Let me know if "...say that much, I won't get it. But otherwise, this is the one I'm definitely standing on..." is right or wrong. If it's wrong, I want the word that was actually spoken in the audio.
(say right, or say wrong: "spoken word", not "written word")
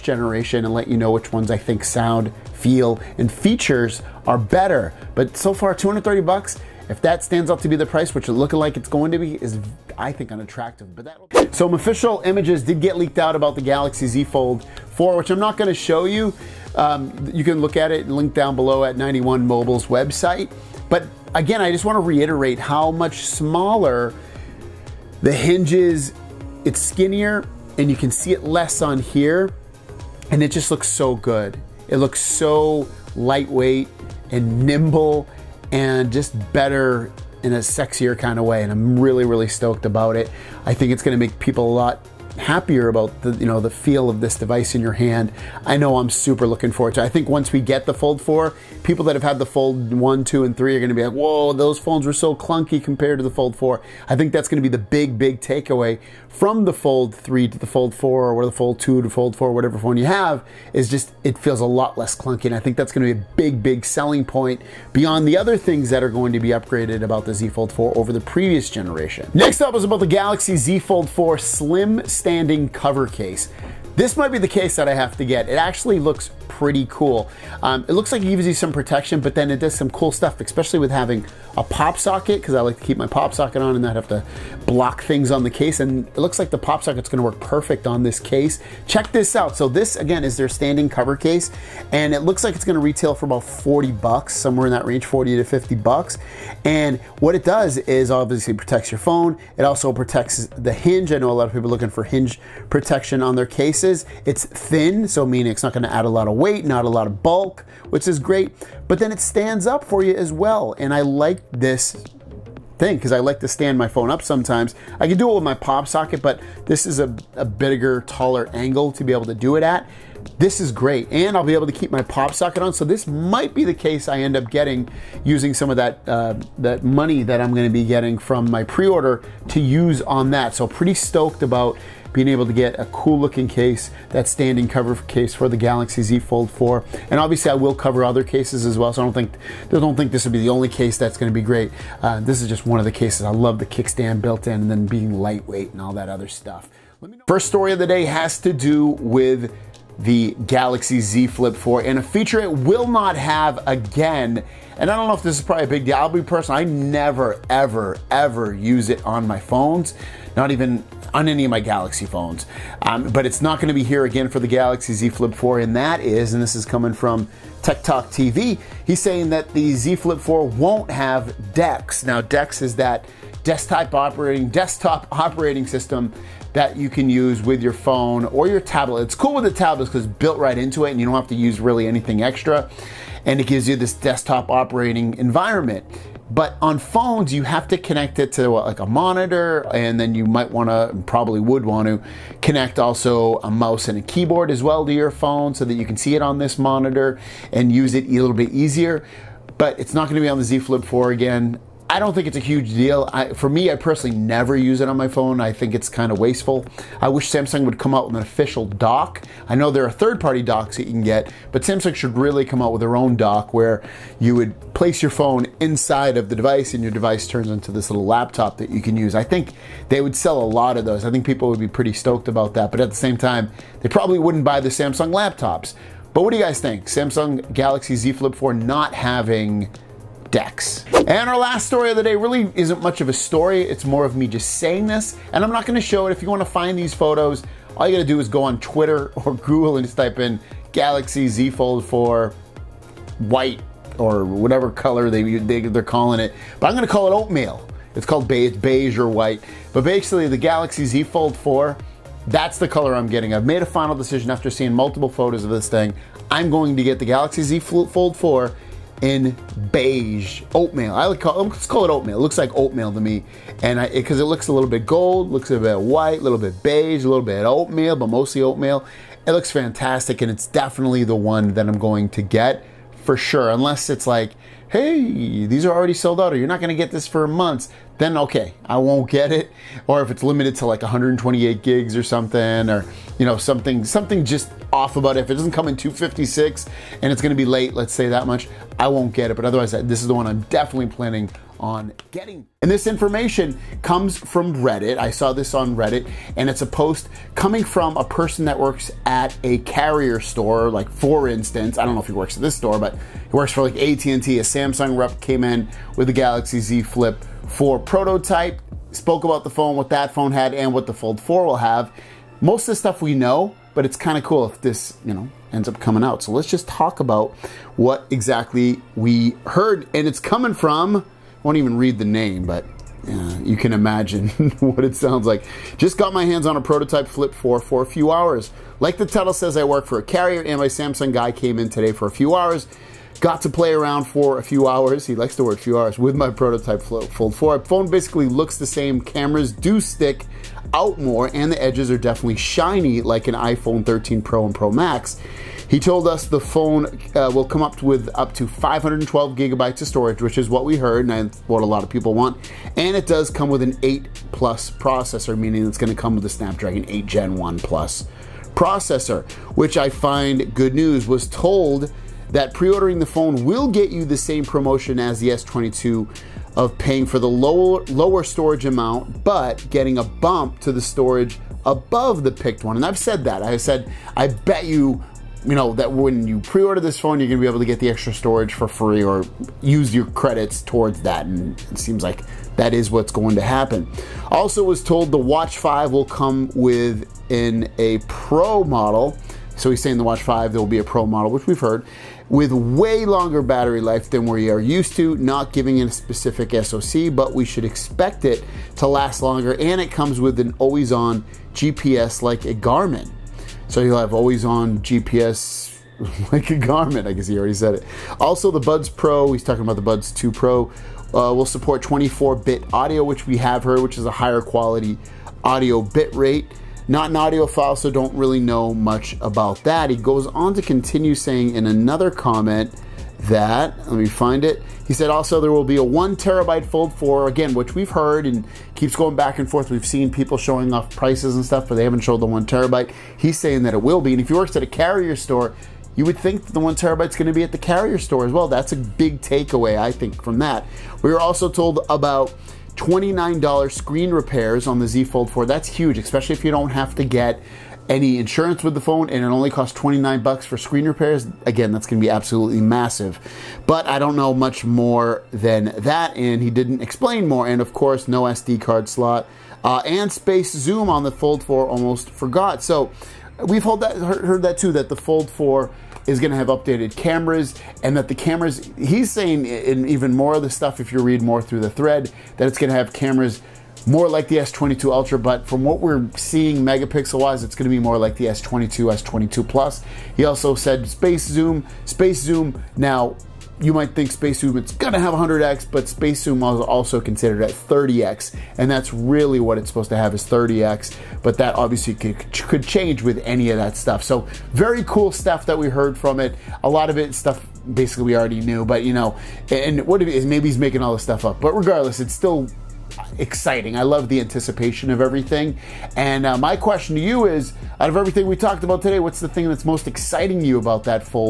wrong: "planning", not "standing".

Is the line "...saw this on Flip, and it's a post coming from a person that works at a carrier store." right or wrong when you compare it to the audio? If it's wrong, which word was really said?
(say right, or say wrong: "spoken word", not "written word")
wrong: "Reddit", not "Flip".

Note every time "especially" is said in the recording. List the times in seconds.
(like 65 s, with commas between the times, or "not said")
80 s, 445 s.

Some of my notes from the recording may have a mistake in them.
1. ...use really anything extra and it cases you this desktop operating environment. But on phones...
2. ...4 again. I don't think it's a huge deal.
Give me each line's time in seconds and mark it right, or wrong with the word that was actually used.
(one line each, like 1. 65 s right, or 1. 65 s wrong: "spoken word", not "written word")
1. 181 s wrong: "gives", not "cases"
2. 200 s right.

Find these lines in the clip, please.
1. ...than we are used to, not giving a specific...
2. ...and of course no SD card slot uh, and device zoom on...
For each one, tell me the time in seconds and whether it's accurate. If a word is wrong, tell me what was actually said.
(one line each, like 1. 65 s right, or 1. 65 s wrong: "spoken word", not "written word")
1. 394 s right
2. 457 s wrong: "space", not "device".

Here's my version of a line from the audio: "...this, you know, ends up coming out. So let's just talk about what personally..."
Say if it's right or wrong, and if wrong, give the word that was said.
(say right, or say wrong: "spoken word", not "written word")
wrong: "exactly", not "personally".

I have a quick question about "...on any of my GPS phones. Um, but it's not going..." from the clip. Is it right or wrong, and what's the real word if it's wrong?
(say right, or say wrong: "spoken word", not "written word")
wrong: "Galaxy", not "GPS".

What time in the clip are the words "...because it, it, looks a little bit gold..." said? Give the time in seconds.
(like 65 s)
263 s.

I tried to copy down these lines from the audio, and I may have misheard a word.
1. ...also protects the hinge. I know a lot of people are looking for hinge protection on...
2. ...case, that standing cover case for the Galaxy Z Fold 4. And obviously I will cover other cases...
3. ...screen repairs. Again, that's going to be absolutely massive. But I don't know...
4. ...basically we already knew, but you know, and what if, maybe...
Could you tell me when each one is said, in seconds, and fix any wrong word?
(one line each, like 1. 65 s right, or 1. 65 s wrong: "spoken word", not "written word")
1. 99 s right
2. 133 s right
3. 450 s right
4. 497 s right.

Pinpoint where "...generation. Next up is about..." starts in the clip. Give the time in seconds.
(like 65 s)
68 s.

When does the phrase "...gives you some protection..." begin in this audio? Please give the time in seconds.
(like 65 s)
78 s.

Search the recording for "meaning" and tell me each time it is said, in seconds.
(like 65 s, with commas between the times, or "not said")
105 s, 355 s.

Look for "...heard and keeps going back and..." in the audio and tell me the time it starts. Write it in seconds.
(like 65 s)
427 s.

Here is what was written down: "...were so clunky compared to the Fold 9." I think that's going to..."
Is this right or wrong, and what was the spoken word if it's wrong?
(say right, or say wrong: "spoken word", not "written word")
wrong: "4", not "9".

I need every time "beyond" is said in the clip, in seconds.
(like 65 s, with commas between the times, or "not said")
64 s.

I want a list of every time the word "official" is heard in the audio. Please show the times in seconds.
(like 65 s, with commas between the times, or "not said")
11 s, 208 s.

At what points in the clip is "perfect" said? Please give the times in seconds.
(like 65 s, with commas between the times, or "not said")
87 s.